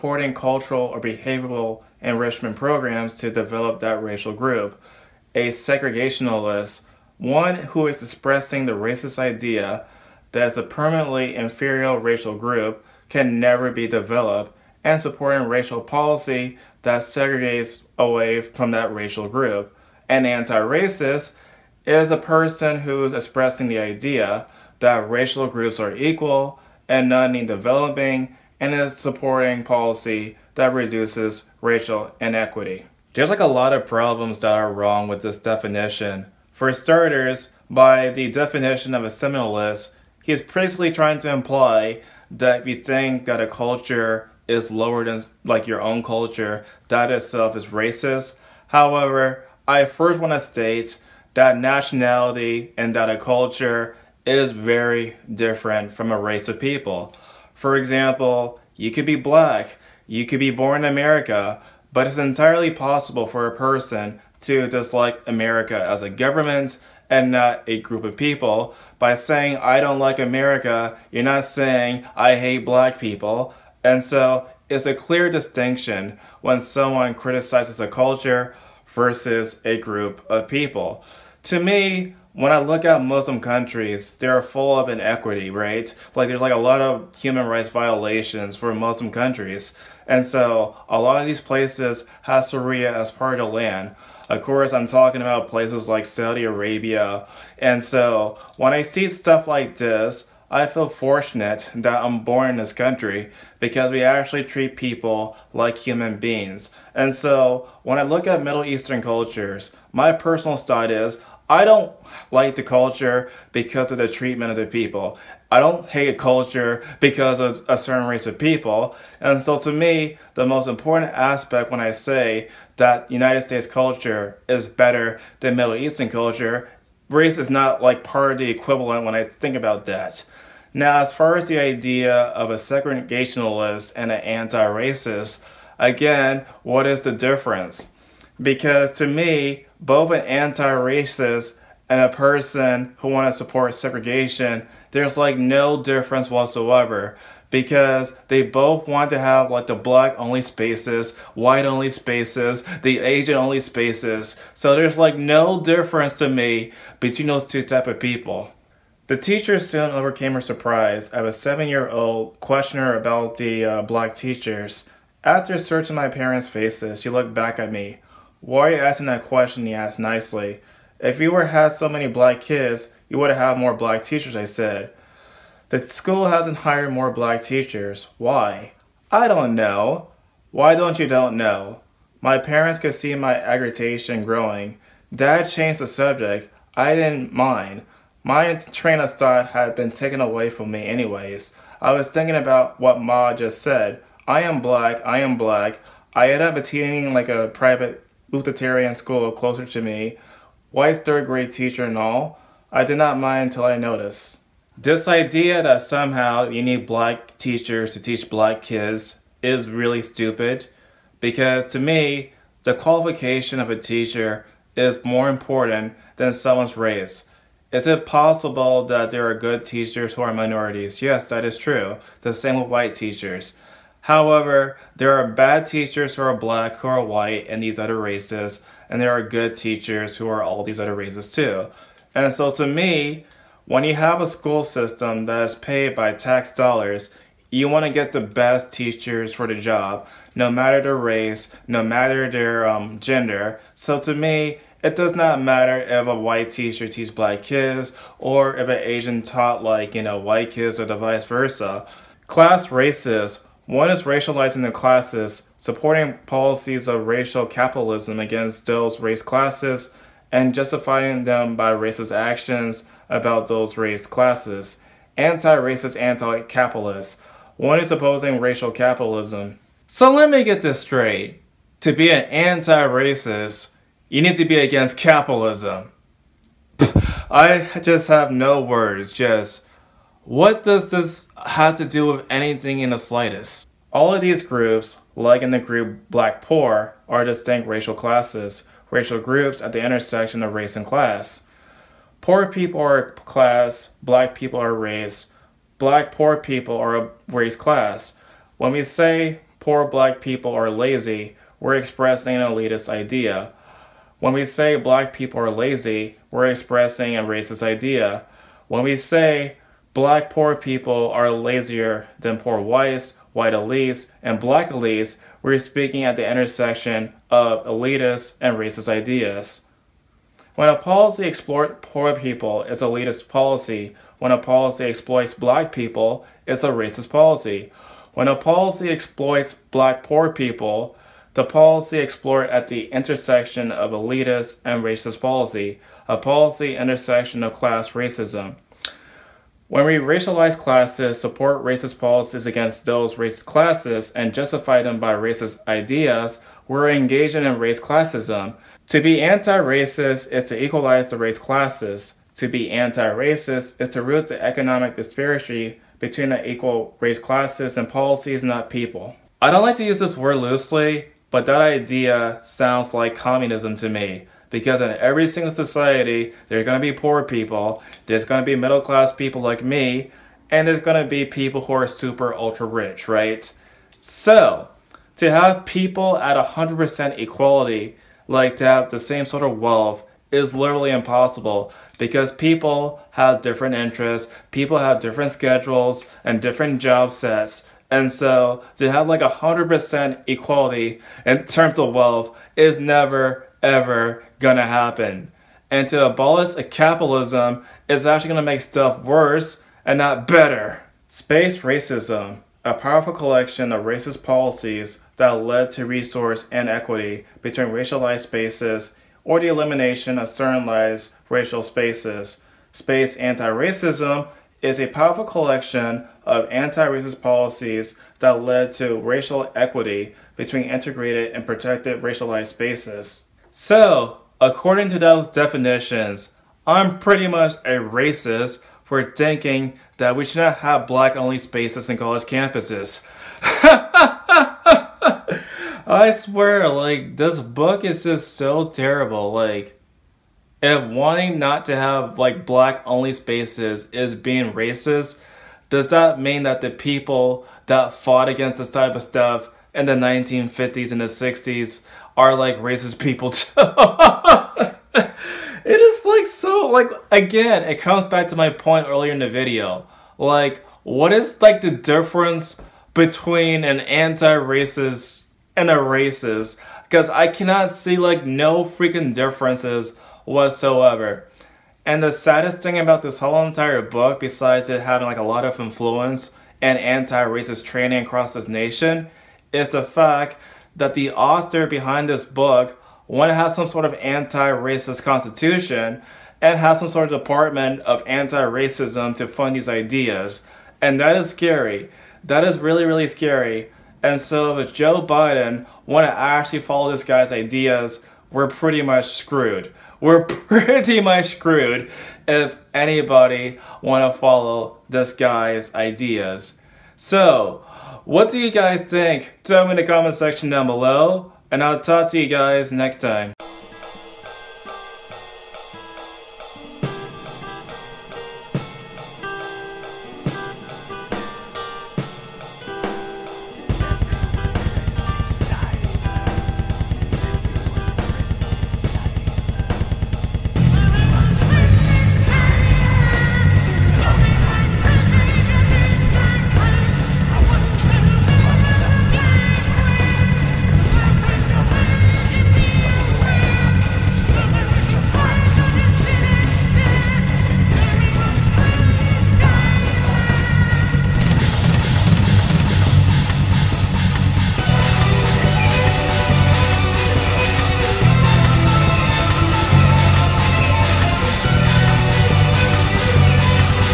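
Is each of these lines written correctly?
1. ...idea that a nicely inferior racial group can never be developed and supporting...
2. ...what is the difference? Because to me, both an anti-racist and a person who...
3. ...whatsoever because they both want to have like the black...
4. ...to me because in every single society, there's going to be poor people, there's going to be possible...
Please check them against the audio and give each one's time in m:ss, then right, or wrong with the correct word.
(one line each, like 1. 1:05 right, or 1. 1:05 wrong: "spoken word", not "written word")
1. 0:09 wrong: "permanently", not "nicely"
2. 2:16 right
3. 2:26 right
4. 6:03 wrong: "middle", not "possible".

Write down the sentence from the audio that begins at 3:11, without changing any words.
I was thinking about what Ma just said.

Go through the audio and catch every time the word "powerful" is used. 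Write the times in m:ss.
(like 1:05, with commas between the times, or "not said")
6:42, 6:54.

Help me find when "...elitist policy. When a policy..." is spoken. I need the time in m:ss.
5:22.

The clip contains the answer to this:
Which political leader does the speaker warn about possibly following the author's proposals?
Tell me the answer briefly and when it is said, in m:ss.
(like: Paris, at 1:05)
Joe Biden, at 8:14.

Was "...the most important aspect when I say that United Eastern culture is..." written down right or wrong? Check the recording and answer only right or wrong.
wrong.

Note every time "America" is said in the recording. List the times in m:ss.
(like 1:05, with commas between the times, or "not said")
1:00, 1:05, 1:10.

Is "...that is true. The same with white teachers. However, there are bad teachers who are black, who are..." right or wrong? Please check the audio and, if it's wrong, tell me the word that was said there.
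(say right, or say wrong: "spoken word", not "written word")
right.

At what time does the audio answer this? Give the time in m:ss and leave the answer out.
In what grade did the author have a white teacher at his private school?
3:20.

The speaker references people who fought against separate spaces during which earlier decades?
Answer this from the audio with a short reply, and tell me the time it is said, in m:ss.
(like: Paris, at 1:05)
1950s and 60s, at 7:29.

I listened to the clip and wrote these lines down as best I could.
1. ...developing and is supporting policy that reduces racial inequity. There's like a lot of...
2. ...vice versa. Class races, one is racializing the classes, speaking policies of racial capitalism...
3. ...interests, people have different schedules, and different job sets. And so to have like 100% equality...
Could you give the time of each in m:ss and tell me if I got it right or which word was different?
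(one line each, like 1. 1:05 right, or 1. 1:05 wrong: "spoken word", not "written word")
1. 0:27 right
2. 4:10 wrong: "supporting", not "speaking"
3. 6:23 right.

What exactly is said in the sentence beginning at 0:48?
However, I first want to state that nationality and that a culture is very different from a race of people.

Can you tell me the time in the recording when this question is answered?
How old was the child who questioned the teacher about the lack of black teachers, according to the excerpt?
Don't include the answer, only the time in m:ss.
2:41.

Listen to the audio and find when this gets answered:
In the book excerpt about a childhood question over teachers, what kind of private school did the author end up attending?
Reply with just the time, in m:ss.
3:18.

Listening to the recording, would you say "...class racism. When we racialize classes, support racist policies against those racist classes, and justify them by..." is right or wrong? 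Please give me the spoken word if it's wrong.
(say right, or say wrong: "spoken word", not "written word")
right.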